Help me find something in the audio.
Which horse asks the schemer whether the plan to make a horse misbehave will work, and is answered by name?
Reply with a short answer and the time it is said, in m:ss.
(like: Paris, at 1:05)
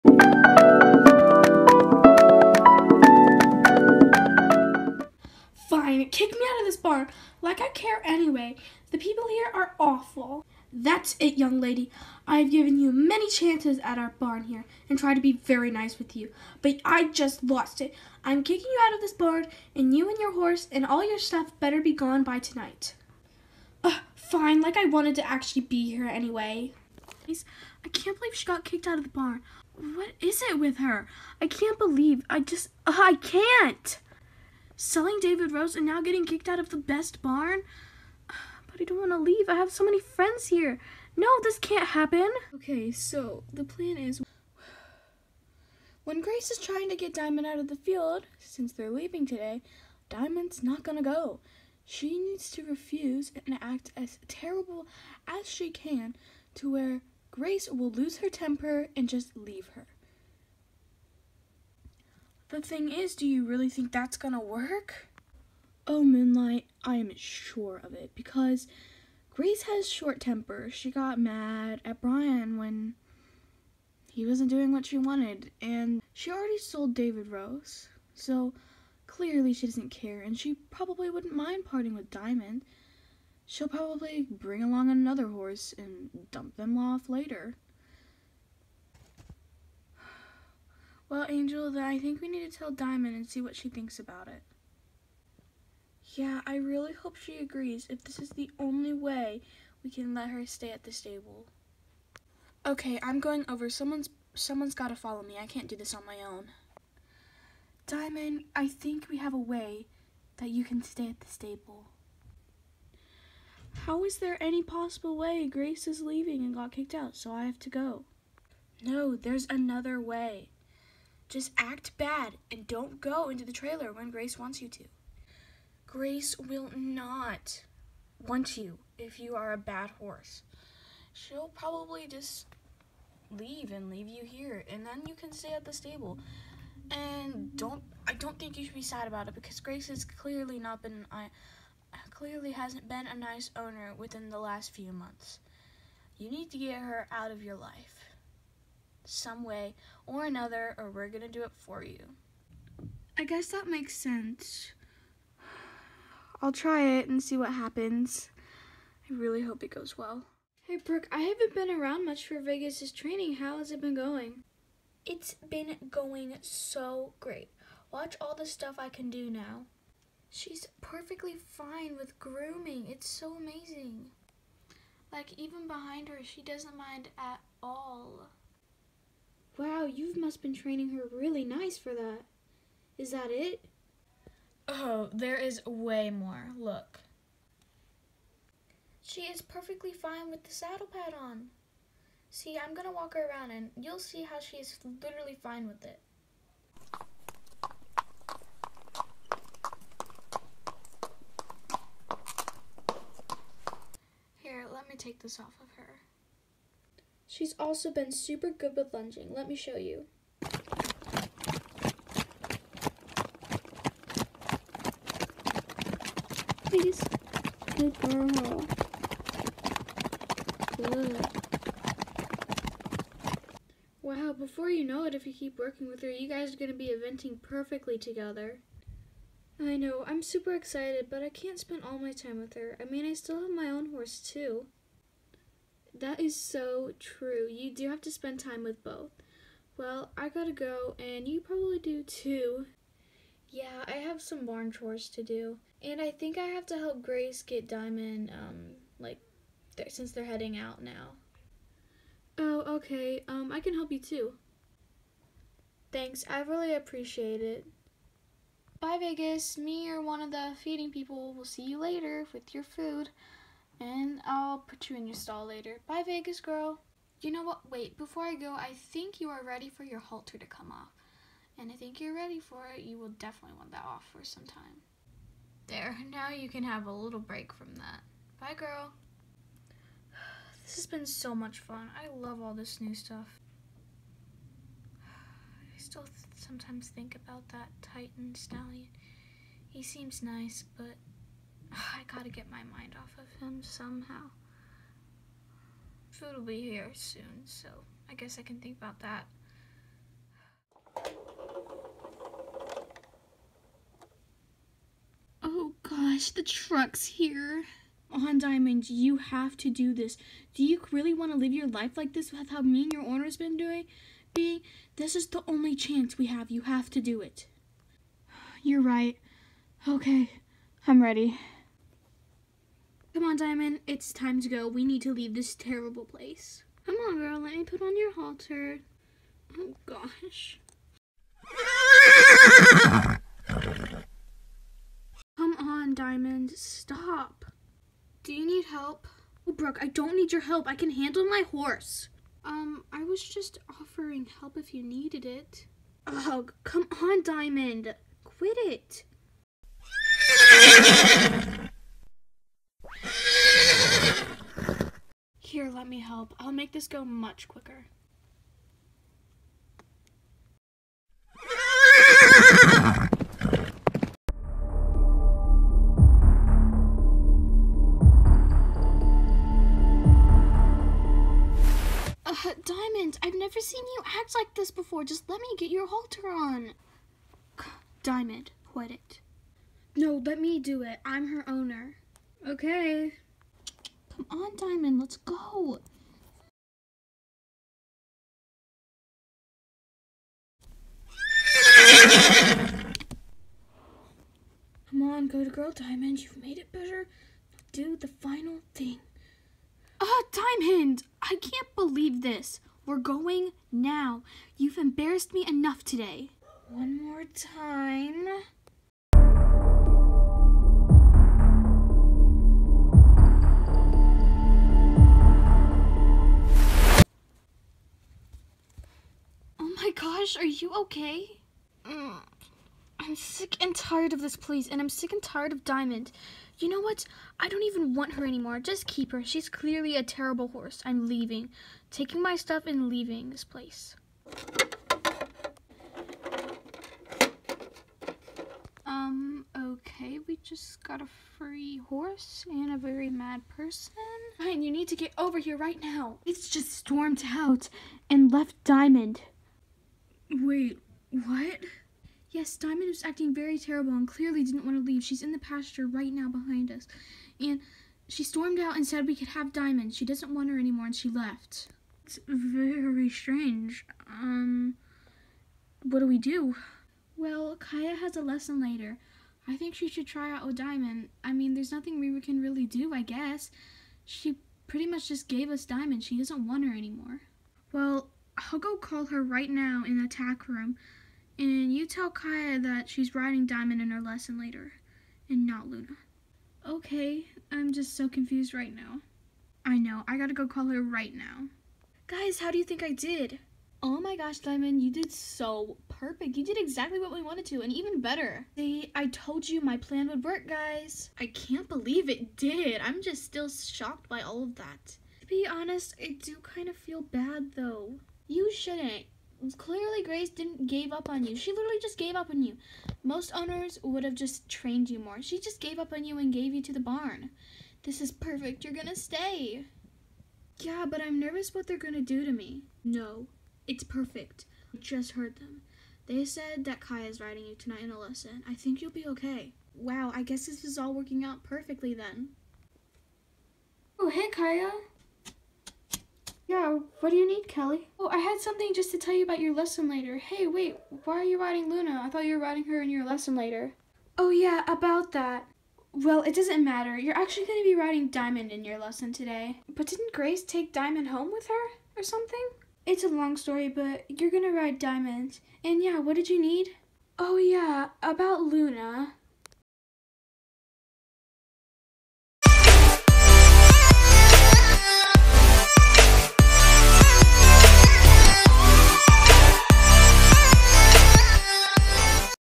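Moonlight, at 1:05.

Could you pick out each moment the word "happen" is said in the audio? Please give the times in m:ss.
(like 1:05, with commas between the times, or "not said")
0:41, 2:37.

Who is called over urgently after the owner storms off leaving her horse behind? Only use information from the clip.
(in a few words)
Ryan.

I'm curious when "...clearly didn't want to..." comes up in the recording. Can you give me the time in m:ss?
7:34.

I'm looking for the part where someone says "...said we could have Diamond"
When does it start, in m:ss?
7:38.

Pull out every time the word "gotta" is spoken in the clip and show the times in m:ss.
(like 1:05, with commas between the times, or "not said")
4:00, 4:52, 8:10.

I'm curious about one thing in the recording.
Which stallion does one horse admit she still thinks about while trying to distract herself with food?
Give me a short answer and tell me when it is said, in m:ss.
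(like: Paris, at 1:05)
Titan, at 4:47.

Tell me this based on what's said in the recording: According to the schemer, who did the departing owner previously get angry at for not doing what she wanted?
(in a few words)
Brian.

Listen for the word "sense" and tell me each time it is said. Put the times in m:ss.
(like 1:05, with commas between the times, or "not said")
2:33.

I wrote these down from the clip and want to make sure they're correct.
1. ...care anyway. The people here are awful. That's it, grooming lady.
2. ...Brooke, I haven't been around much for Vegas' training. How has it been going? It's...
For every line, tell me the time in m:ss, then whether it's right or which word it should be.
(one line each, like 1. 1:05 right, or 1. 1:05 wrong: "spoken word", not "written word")
1. 0:07 wrong: "young", not "grooming"
2. 2:40 right.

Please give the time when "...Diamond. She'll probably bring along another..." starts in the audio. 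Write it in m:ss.
1:22.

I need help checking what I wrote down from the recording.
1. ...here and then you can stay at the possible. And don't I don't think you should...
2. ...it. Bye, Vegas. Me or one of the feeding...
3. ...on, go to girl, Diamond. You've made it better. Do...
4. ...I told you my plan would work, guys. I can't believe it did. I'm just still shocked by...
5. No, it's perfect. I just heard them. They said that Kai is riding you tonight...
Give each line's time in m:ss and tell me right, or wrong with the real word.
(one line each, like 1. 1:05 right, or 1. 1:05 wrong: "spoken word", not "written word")
1. 2:14 wrong: "stable", not "possible"
2. 4:17 right
3. 6:35 right
4. 8:18 right
5. 8:42 right.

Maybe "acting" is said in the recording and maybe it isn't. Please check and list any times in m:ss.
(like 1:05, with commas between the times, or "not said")
7:33.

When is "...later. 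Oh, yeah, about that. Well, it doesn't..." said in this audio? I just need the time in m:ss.
9:03.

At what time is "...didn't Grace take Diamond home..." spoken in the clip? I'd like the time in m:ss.
9:09.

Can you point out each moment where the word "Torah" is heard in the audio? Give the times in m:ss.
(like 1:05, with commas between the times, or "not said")
not said.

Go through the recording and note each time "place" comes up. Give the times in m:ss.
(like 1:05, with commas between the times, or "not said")
5:26, 7:04, 7:13.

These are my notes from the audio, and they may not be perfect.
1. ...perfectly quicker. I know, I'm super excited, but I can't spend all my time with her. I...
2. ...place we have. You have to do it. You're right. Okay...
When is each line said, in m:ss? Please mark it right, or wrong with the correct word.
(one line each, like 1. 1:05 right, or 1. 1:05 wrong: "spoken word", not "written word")
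1. 3:47 wrong: "together", not "quicker"
2. 5:15 wrong: "chance", not "place".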